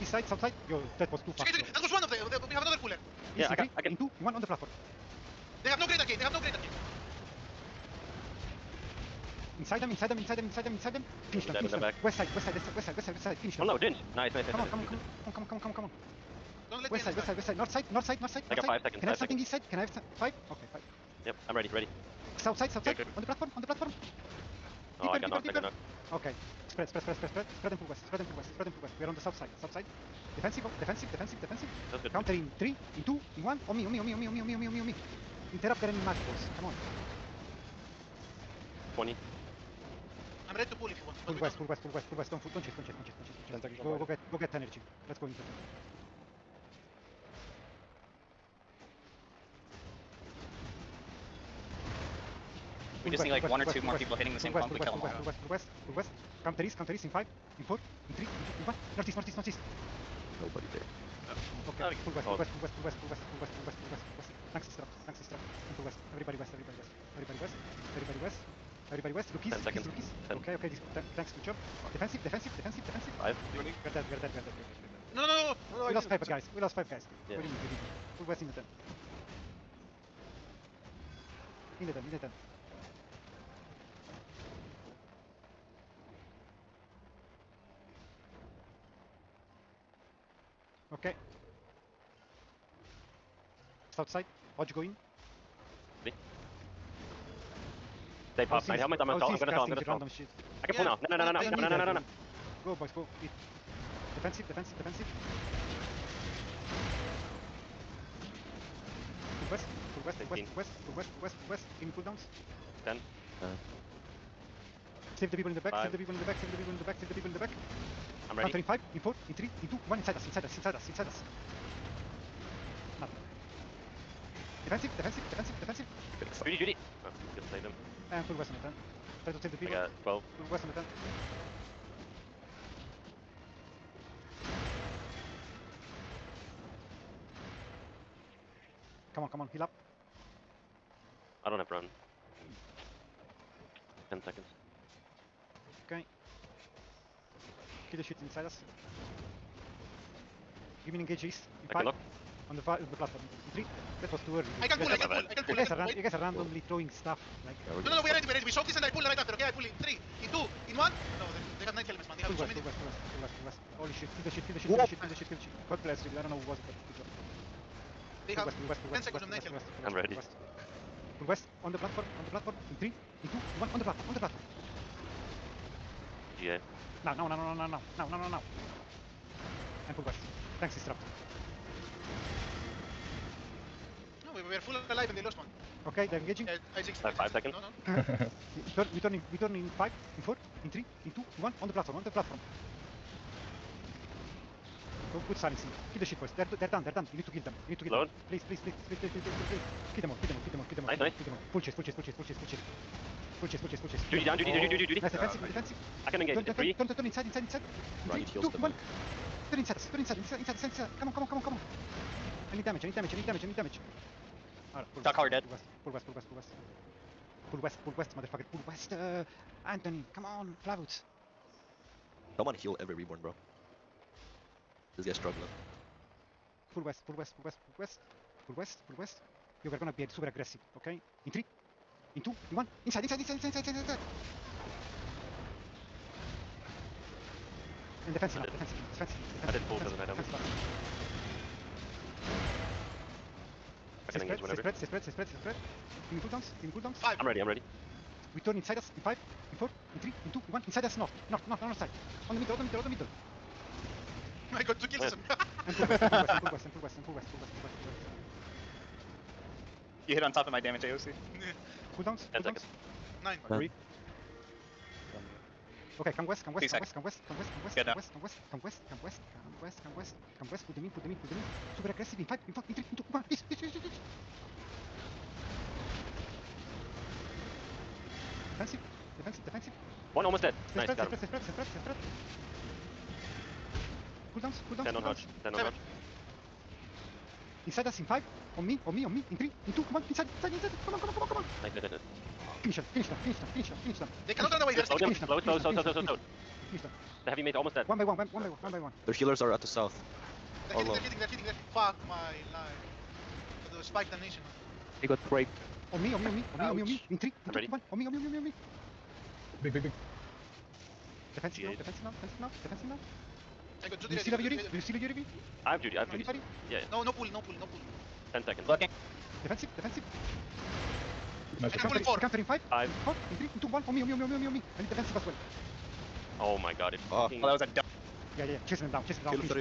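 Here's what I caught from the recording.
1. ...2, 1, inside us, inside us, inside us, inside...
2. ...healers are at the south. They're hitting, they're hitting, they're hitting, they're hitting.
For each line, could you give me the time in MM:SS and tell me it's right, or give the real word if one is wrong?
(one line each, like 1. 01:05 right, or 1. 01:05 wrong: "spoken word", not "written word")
1. 01:59 right
2. 04:59 right.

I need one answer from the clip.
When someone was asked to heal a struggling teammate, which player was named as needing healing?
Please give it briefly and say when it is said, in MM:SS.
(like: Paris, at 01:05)
Reborn, at 03:42.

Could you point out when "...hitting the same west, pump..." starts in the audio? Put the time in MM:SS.
00:54.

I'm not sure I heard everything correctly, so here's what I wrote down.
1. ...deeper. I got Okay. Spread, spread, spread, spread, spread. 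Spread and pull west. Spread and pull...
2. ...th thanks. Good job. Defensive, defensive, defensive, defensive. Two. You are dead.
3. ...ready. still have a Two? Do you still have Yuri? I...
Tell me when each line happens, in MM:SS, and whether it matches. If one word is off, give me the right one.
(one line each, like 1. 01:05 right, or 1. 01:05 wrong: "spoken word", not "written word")
1. 00:25 right
2. 01:10 wrong: "Five", not "Two"
3. 05:14 wrong: "Yuri", not "Two".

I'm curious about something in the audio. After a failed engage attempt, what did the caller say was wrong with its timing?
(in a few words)
too early.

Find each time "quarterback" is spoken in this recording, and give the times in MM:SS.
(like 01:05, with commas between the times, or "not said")
not said.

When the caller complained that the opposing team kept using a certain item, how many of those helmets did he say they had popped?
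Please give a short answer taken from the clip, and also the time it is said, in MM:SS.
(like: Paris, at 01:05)
9, at 01:38.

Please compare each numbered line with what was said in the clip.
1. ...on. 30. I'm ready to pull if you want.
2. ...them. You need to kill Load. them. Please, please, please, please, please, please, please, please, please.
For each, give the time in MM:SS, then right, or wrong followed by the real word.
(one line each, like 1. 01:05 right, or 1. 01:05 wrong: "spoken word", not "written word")
1. 00:36 wrong: "20", not "30"
2. 03:17 right.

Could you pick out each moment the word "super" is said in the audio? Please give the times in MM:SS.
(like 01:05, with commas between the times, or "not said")
03:50, 04:31.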